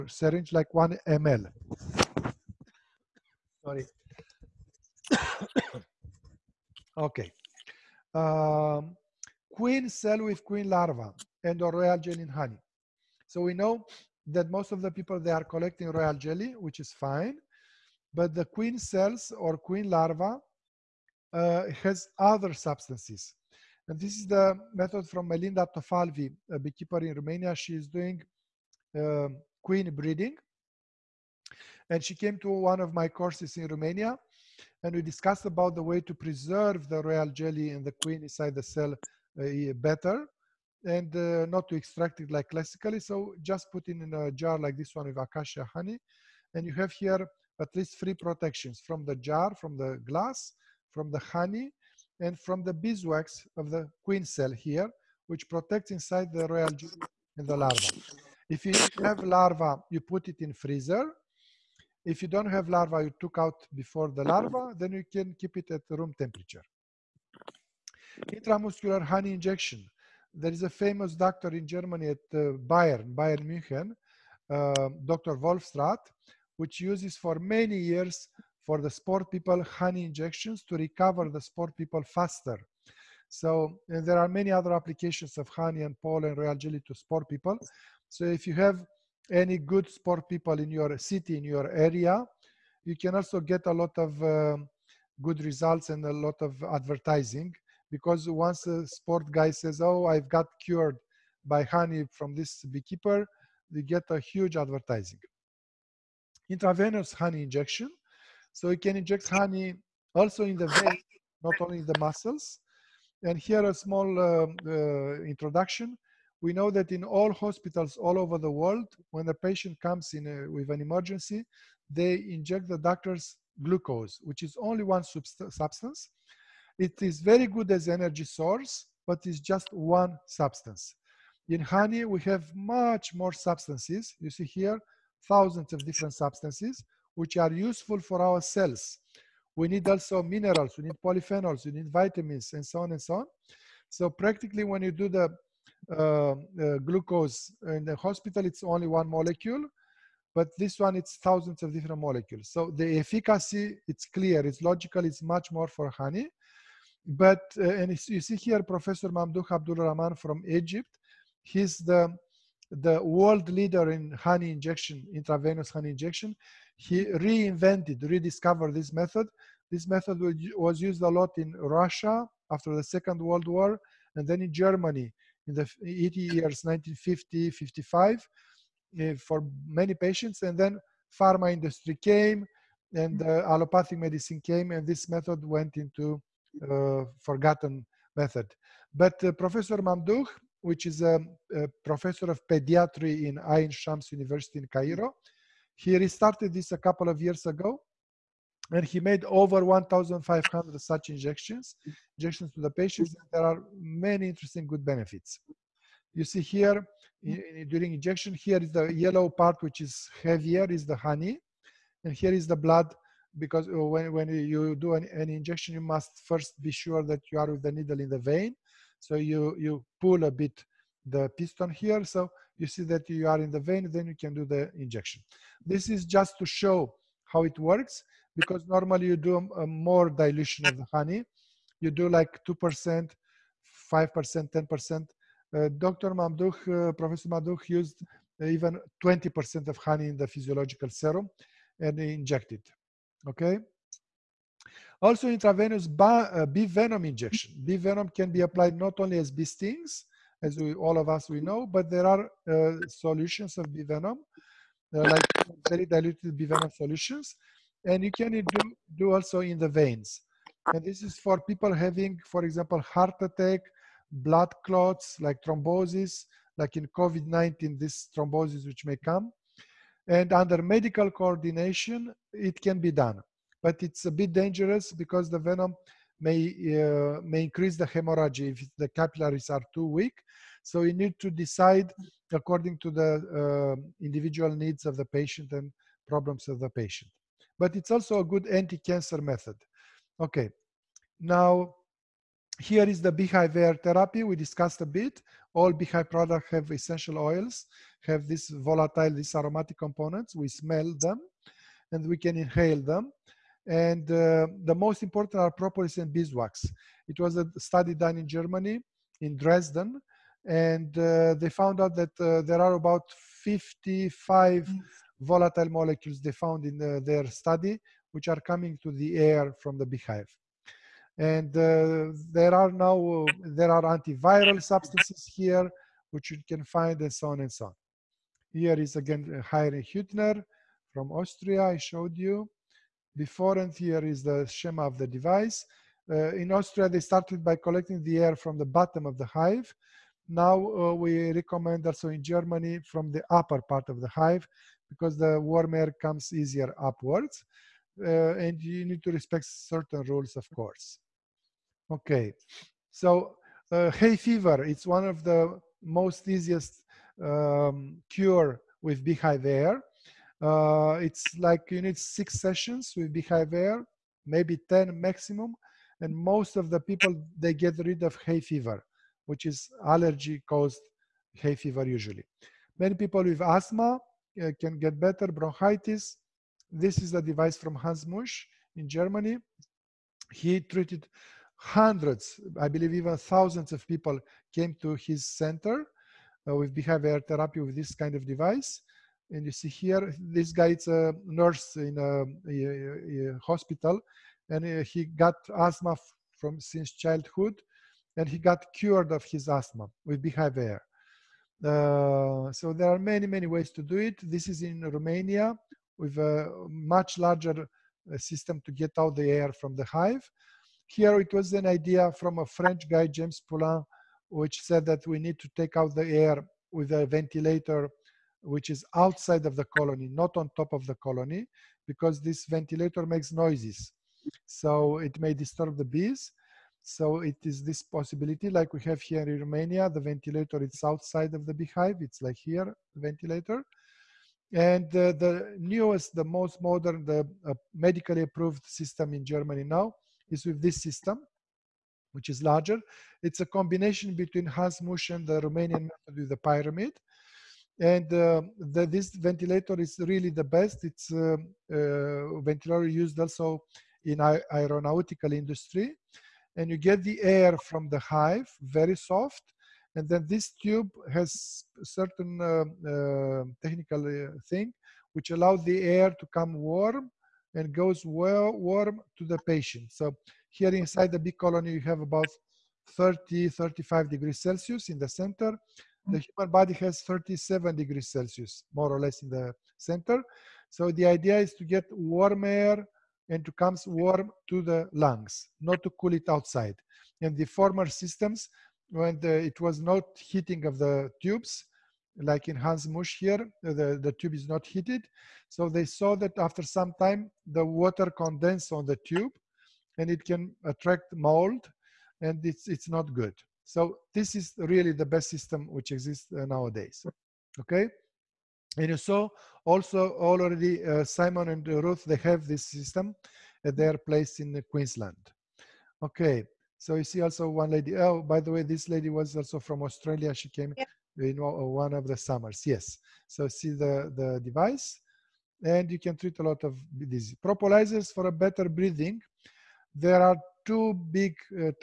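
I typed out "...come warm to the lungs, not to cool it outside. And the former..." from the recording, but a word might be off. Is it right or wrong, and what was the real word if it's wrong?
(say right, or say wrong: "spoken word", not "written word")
right.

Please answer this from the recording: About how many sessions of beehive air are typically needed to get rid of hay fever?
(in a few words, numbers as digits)
6.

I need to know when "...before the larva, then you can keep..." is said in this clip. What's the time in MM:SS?
01:03.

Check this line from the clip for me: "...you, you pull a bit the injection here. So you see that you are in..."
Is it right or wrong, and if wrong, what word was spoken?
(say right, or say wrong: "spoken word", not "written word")
wrong: "piston", not "injection".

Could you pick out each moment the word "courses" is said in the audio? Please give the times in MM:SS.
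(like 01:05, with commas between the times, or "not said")
00:33, 05:50.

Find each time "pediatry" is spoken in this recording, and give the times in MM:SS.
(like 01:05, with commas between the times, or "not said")
03:12.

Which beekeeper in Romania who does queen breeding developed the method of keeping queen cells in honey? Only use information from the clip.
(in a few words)
Melinda Tofalvi.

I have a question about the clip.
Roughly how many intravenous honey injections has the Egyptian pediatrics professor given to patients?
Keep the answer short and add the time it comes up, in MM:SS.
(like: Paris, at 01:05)
over 1,500, at 03:19.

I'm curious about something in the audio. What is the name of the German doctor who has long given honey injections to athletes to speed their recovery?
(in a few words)
Dr. Wohlfahrt.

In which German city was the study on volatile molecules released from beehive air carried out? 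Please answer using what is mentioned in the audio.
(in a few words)
Dresden.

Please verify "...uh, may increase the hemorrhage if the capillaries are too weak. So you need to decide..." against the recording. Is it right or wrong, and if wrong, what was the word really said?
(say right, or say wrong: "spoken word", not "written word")
right.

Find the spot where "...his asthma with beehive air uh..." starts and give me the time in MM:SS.
06:39.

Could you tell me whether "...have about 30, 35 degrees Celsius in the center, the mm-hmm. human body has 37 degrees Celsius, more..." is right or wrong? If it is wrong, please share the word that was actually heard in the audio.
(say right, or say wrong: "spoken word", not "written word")
right.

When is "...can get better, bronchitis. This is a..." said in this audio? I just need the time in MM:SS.
06:14.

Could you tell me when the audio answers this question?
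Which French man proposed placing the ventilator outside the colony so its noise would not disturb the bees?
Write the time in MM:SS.
06:53.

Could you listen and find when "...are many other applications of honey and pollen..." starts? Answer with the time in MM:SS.
01:24.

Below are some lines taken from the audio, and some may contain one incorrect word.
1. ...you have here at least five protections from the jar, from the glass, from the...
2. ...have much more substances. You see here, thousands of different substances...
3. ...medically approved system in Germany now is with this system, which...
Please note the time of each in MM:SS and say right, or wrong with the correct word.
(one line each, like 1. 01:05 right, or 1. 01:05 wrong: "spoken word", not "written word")
1. 00:46 wrong: "three", not "five"
2. 02:12 right
3. 07:17 right.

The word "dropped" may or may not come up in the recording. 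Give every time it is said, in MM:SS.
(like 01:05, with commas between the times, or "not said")
not said.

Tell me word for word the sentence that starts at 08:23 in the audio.
So this is really the best system which exists uh, nowadays.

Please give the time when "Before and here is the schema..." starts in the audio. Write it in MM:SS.
05:33.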